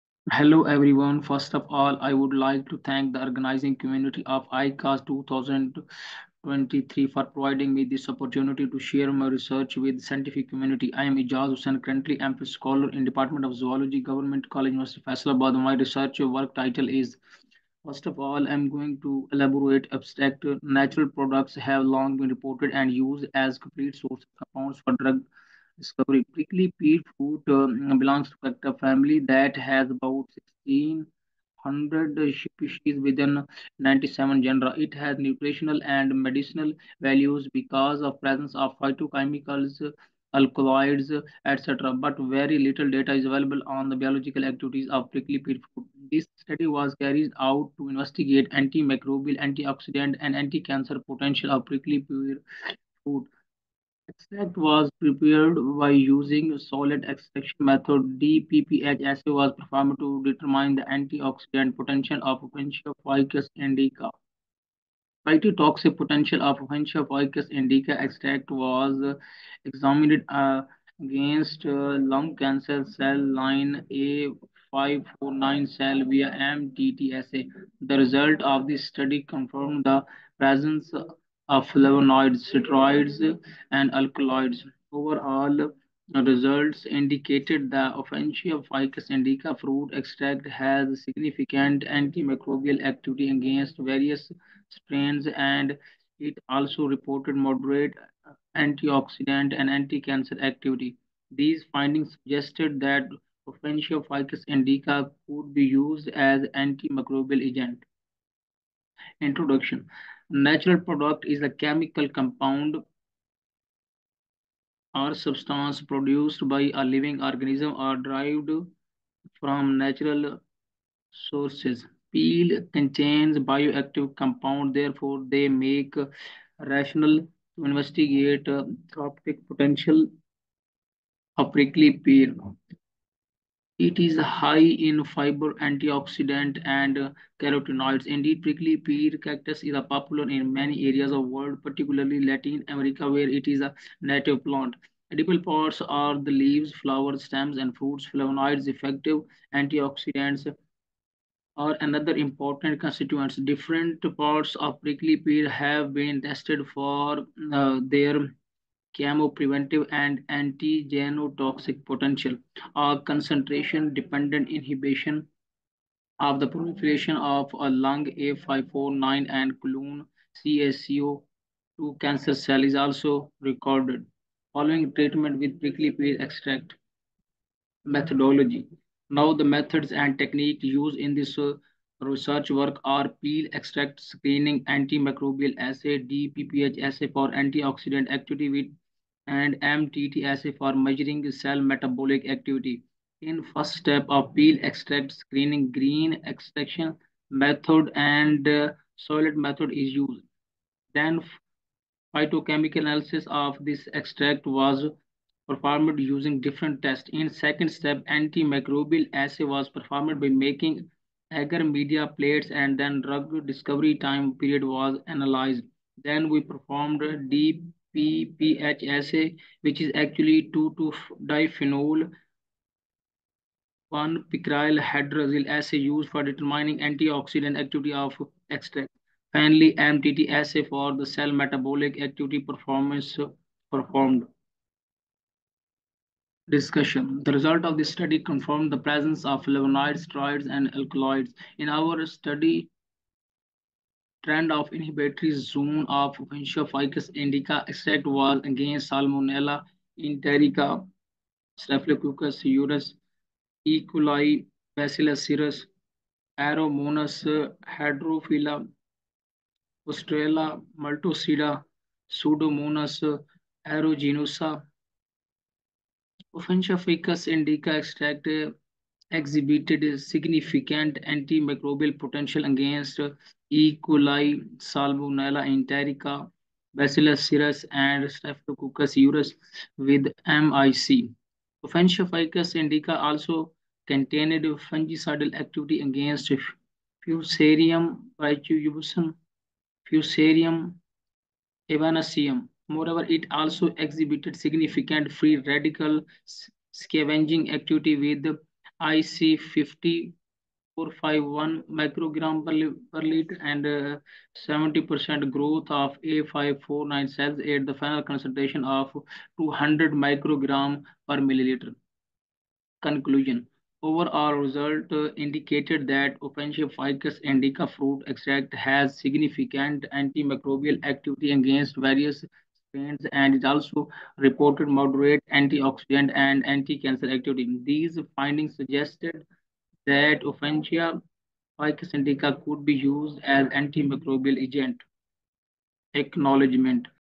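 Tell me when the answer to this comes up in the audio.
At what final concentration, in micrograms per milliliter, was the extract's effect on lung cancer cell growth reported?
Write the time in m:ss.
5:09.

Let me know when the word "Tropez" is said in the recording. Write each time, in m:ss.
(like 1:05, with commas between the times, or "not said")
not said.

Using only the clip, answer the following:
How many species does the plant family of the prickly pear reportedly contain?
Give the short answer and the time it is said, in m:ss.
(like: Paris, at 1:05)
1600, at 0:30.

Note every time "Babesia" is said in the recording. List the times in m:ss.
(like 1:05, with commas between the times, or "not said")
4:06, 4:26.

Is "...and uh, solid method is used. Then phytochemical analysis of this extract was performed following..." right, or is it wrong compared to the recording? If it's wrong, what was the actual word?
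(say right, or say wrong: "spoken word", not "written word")
wrong: "using", not "following".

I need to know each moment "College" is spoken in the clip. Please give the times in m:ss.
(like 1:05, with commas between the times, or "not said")
0:14.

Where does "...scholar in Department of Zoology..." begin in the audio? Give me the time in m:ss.
0:12.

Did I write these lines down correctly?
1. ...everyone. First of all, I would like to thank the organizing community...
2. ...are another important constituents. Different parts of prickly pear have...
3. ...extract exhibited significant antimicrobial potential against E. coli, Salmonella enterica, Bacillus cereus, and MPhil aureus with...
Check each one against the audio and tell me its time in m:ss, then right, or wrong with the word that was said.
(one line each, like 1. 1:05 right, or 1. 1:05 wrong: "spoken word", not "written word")
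1. 0:00 right
2. 2:31 right
3. 4:27 wrong: "Staphylococcus", not "MPhil".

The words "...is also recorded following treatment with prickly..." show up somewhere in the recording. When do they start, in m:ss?
2:52.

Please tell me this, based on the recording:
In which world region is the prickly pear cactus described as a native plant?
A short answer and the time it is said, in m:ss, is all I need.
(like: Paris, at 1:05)
Latin America, at 2:22.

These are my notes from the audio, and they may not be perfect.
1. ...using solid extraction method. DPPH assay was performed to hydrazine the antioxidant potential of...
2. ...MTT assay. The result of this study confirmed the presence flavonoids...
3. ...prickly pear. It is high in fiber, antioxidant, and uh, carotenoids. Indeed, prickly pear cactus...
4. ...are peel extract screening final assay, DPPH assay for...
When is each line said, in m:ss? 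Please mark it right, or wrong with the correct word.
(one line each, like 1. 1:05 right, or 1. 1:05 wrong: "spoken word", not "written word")
1. 0:55 wrong: "determine", not "hydrazine"
2. 1:16 right
3. 2:11 right
4. 3:02 wrong: "antimicrobial", not "final".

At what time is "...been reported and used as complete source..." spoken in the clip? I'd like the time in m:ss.
0:22.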